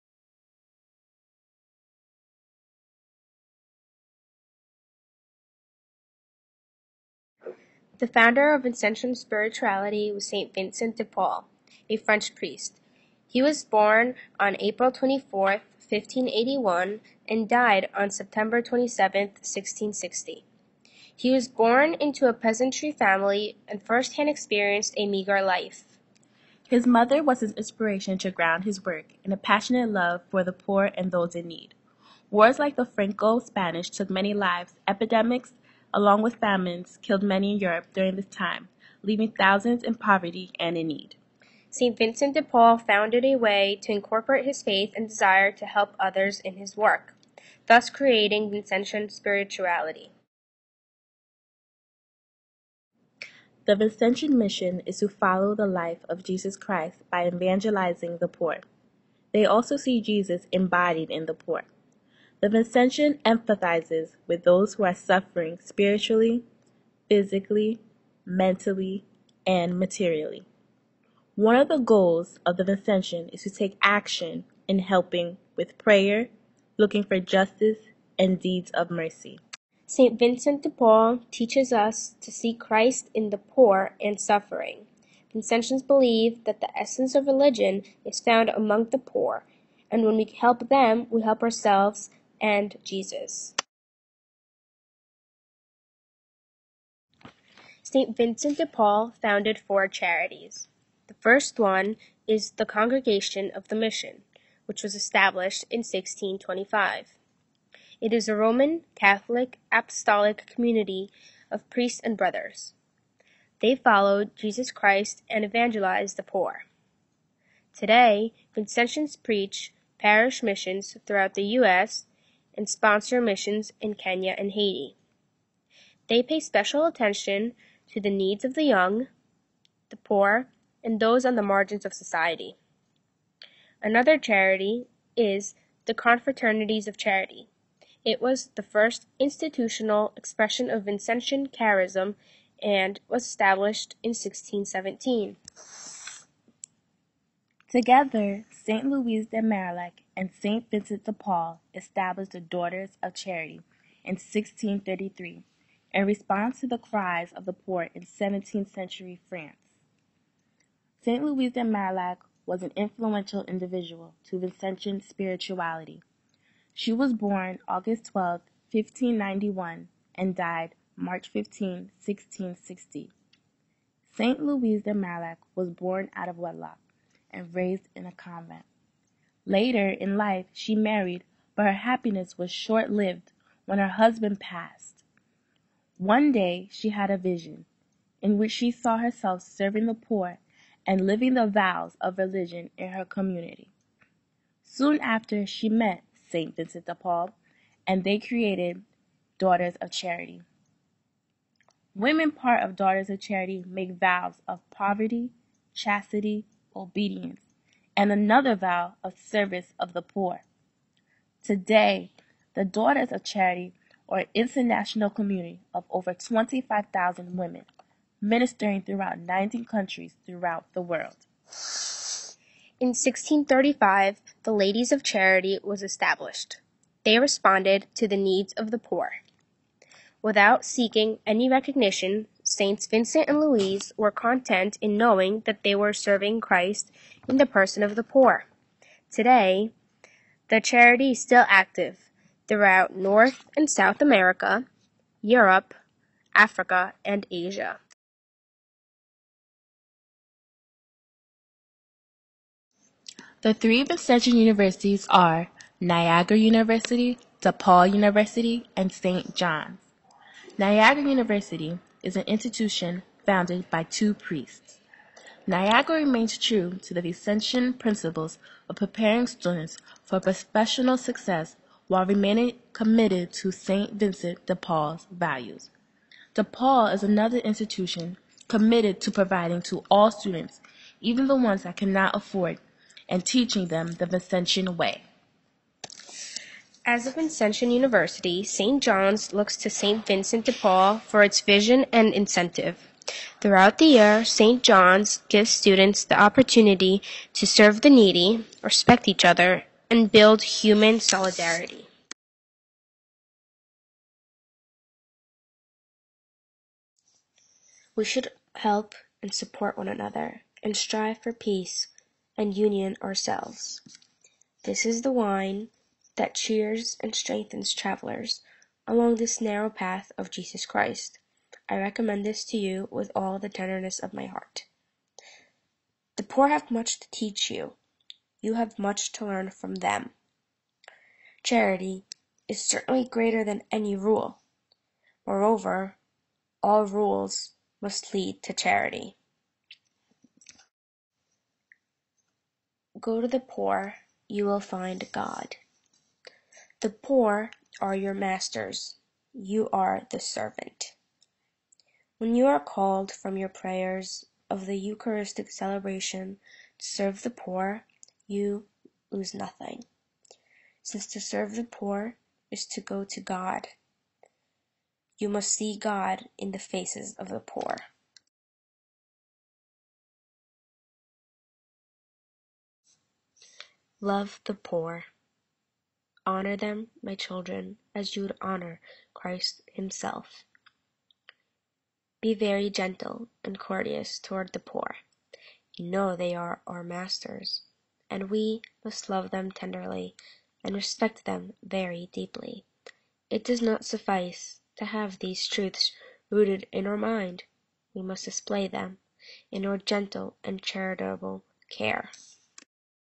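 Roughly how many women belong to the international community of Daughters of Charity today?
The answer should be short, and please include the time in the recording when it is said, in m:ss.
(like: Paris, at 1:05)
25,000, at 3:36.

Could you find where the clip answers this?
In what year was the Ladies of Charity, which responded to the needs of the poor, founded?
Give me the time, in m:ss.
3:42.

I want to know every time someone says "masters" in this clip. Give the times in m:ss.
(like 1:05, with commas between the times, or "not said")
5:48, 6:26.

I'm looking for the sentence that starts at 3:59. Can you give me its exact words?
Today, the charity is still active throughout North and South America, Europe, Africa, and Asia.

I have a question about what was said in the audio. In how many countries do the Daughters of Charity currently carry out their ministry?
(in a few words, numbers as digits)
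19.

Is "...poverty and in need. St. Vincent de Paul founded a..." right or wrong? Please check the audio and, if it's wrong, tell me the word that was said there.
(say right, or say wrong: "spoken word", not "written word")
right.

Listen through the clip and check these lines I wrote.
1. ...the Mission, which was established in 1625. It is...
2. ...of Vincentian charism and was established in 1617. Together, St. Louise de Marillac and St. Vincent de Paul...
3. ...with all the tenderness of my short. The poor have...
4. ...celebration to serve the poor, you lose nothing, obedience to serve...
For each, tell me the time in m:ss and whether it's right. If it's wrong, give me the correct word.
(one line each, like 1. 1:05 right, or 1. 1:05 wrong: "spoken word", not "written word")
1. 1:43 right
2. 2:20 right
3. 5:22 wrong: "heart", not "short"
4. 5:55 wrong: "since", not "obedience".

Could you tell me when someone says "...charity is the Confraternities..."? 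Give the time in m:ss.
2:14.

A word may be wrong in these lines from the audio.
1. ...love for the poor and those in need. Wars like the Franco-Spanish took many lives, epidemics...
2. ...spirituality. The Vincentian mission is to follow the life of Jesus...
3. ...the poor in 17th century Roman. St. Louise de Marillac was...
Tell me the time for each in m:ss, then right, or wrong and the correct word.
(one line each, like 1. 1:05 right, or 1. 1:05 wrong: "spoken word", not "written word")
1. 0:29 right
2. 0:49 right
3. 2:37 wrong: "France", not "Roman".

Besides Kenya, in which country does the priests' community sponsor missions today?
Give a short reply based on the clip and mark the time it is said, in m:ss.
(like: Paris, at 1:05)
Haiti, at 2:04.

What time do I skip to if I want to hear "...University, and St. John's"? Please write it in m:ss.
4:17.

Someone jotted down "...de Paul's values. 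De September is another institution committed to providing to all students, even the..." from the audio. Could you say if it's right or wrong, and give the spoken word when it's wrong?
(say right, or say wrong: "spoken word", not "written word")
wrong: "Paul", not "September".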